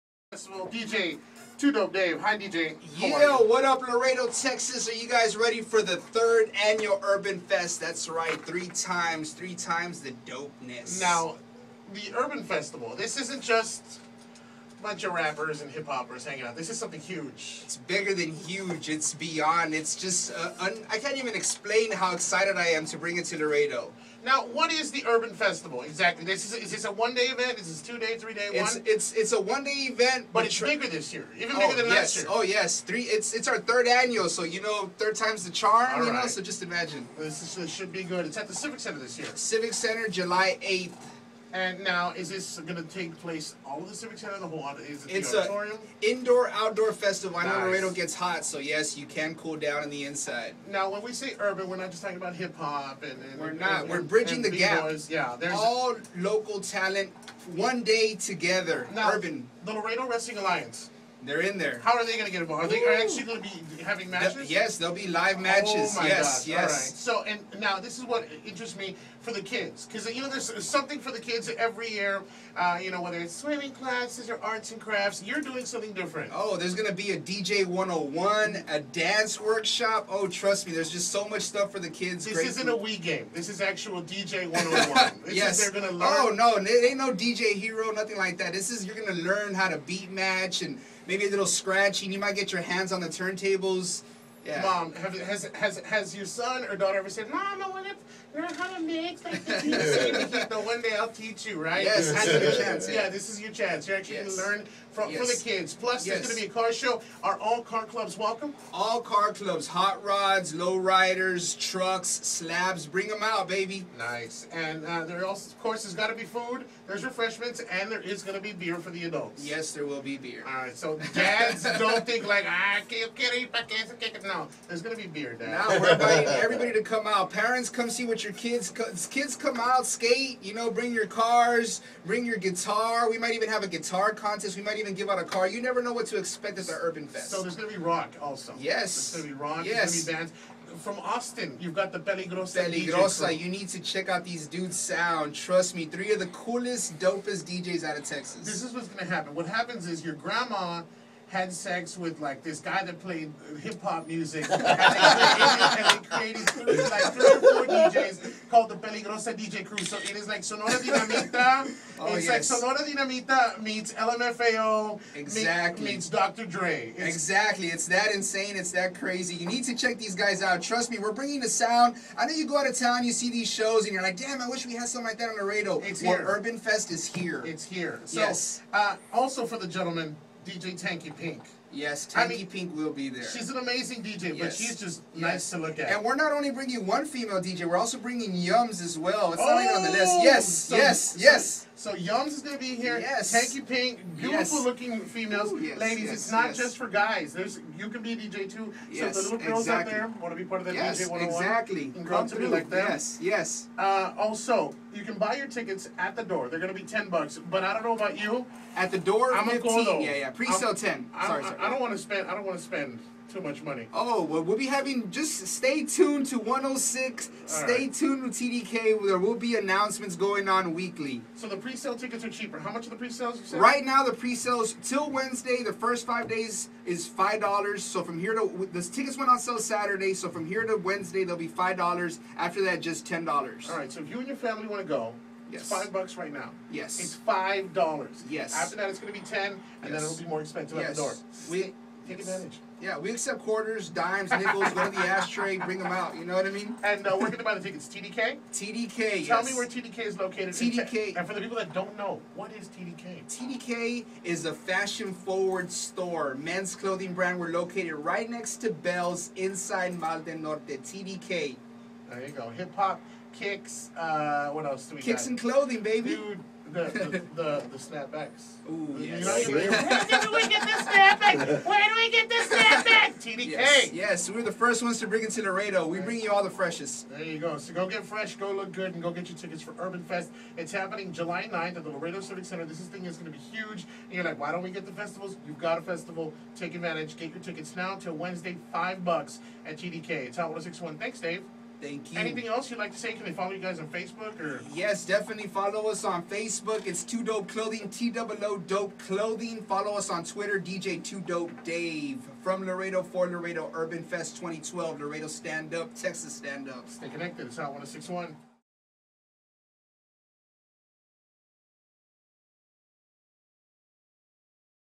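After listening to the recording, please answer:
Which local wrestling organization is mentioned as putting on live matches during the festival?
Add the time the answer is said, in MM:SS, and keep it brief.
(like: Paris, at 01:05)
Laredo Wrestling Alliance, at 00:59.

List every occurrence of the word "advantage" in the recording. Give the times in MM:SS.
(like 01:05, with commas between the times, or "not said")
04:02, 04:46.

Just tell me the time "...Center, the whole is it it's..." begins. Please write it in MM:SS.
00:44.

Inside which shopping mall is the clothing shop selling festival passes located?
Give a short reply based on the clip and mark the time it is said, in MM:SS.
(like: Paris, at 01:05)
Mall del Norte, at 04:19.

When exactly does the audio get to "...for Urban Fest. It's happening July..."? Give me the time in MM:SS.
04:39.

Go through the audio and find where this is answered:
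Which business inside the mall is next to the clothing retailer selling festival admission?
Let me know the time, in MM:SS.
04:18.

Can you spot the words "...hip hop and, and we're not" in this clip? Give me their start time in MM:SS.
00:52.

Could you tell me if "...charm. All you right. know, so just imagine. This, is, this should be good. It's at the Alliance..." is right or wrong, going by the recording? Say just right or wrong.
wrong.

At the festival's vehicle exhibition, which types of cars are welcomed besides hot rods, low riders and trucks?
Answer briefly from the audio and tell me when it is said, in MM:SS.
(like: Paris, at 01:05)
slabs, at 01:52.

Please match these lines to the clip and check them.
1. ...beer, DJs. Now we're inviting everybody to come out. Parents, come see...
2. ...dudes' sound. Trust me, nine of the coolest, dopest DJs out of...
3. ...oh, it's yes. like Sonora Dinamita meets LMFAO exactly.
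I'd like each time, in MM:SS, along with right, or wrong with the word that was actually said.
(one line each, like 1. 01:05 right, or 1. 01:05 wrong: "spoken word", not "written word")
1. 02:05 wrong: "Dad", not "DJs"
2. 02:24 wrong: "three", not "nine"
3. 02:41 right.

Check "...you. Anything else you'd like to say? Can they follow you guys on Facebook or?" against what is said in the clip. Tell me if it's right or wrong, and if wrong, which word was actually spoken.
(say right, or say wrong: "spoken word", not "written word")
right.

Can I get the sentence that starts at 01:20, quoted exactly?
Oh, trust me, there's just so much stuff for the kids.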